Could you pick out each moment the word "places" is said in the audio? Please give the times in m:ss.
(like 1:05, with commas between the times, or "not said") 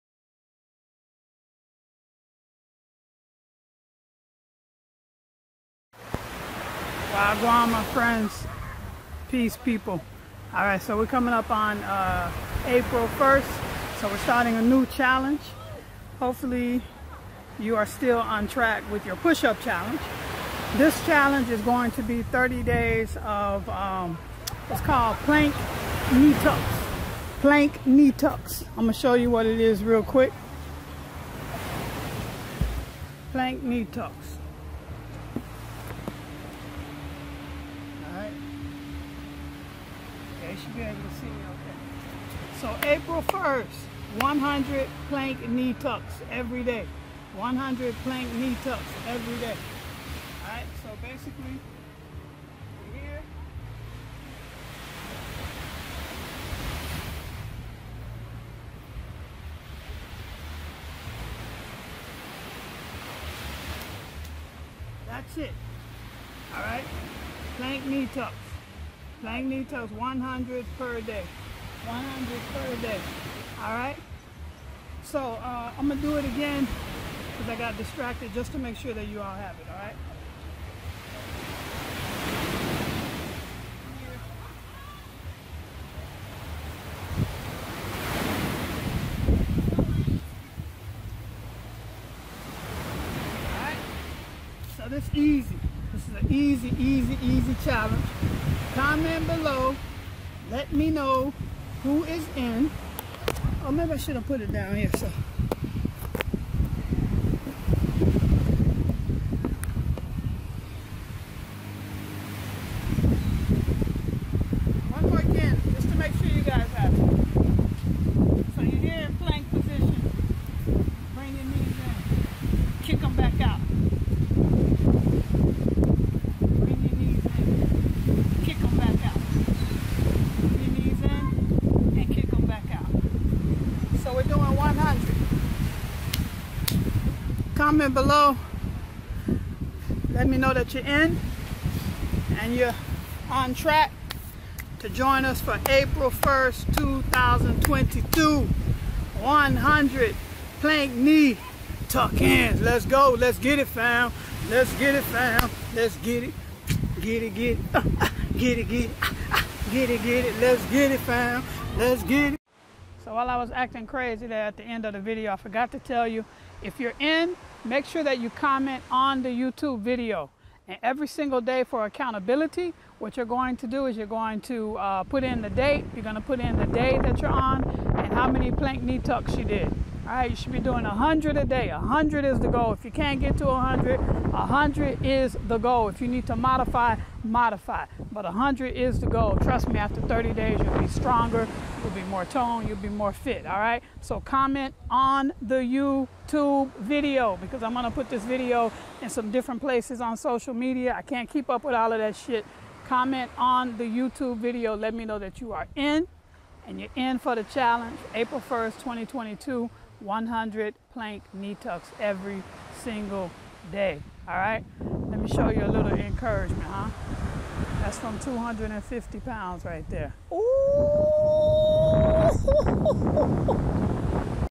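3:19.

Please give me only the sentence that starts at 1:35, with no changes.
This is an easy, easy, easy challenge comment below.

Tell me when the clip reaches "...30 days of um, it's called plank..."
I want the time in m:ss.
0:22.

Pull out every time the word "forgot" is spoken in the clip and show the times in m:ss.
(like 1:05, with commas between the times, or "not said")
2:45.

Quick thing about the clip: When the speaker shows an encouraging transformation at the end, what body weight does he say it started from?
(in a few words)
250 pounds.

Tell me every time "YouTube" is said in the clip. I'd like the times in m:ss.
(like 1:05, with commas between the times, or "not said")
2:49, 3:15, 3:23.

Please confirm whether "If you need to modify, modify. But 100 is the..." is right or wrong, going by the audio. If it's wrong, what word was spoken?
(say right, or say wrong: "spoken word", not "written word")
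right.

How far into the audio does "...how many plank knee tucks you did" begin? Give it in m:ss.
2:58.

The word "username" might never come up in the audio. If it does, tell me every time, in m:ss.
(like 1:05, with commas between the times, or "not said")
not said.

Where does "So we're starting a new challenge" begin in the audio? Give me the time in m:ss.
0:13.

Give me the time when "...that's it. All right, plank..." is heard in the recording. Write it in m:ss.
1:05.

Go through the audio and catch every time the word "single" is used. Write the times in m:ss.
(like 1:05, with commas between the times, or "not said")
2:51, 3:32.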